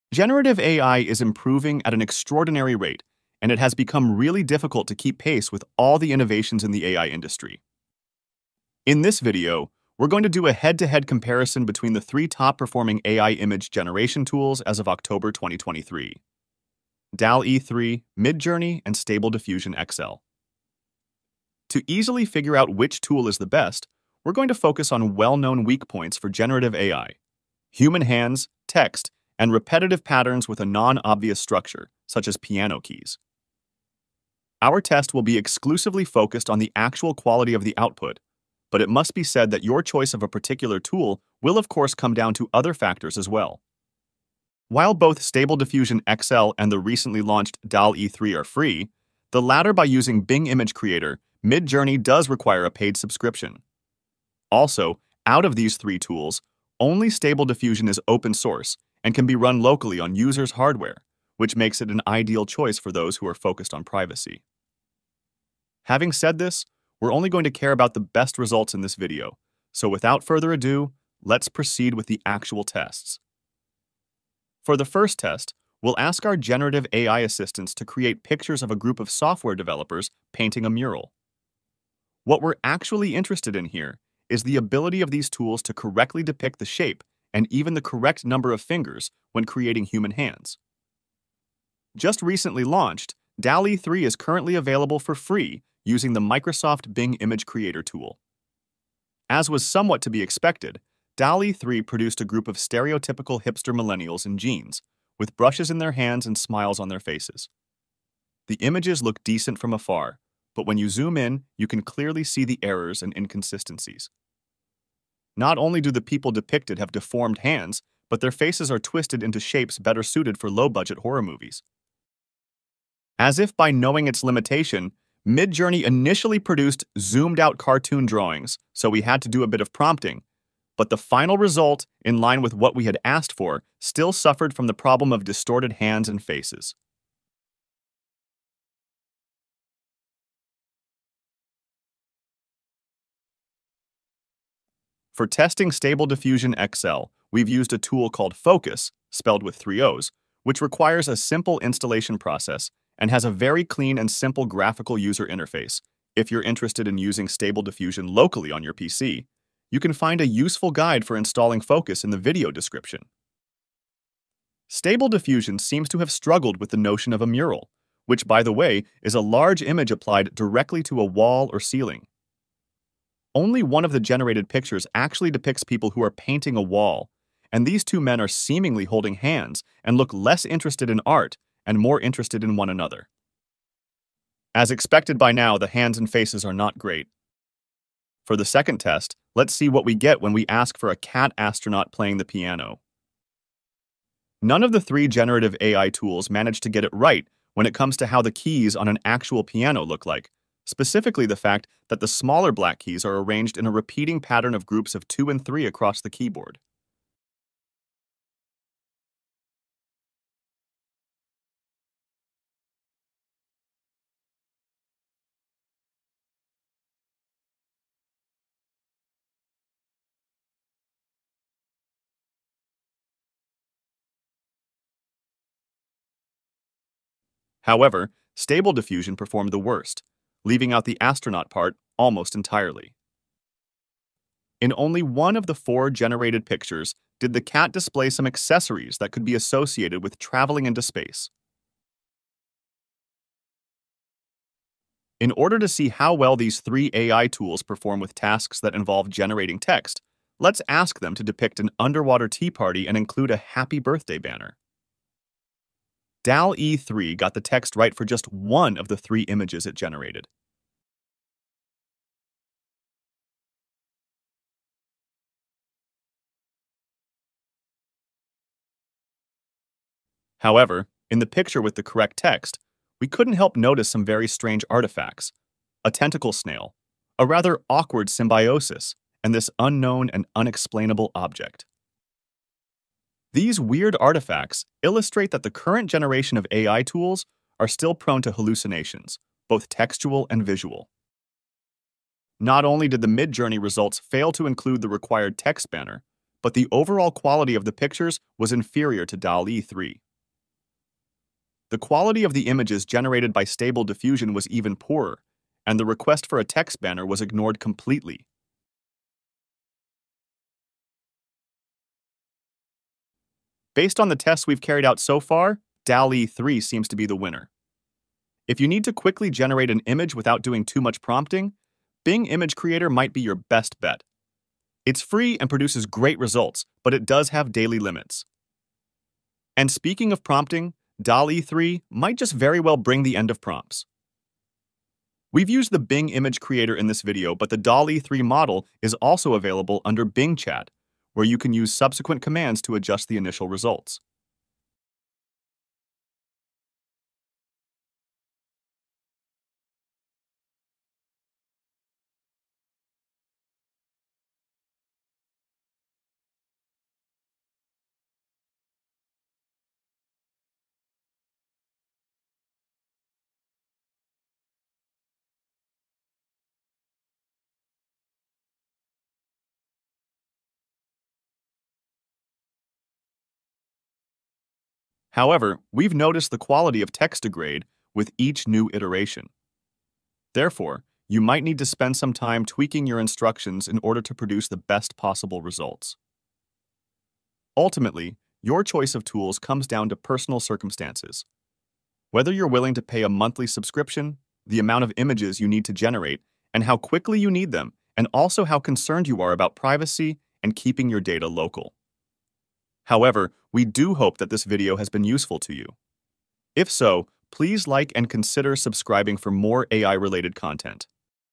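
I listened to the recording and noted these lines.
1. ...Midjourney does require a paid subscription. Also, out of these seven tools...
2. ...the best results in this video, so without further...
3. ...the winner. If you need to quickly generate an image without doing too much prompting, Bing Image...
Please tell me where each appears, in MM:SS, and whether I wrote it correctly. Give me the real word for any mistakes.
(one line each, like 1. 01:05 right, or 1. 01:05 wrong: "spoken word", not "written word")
1. 00:51 wrong: "three", not "seven"
2. 01:07 right
3. 05:17 right.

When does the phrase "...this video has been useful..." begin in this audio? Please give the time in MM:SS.
06:44.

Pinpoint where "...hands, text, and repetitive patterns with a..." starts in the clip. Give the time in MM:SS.
00:28.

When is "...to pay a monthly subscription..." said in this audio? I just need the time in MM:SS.
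06:32.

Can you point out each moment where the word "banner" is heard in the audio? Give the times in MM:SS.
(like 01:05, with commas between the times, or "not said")
04:14, 04:55, 05:06.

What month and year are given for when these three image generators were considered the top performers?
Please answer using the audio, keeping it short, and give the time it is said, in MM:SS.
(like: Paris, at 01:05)
October 2023, at 00:14.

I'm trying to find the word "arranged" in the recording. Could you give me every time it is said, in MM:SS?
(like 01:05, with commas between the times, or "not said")
03:23.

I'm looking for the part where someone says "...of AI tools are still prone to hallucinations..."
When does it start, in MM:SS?
04:46.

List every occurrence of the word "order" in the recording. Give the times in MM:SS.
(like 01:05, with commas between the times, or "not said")
04:05, 06:23.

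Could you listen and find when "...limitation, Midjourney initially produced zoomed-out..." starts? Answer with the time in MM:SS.
02:04.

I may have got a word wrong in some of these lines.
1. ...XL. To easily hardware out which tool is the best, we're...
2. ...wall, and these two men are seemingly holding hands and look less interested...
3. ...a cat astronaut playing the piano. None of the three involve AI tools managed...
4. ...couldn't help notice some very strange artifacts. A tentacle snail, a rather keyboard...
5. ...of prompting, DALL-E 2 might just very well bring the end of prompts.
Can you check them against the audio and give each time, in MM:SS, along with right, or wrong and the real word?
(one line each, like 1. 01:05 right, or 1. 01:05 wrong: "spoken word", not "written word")
1. 00:19 wrong: "figure", not "hardware"
2. 02:56 right
3. 03:10 wrong: "generative", not "involve"
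4. 04:33 wrong: "awkward", not "keyboard"
5. 05:30 wrong: "3", not "2".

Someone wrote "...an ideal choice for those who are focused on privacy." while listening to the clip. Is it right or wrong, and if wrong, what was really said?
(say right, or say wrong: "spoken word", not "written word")
right.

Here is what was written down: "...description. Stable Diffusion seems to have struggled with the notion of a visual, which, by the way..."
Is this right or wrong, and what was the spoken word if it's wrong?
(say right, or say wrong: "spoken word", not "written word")
wrong: "mural", not "visual".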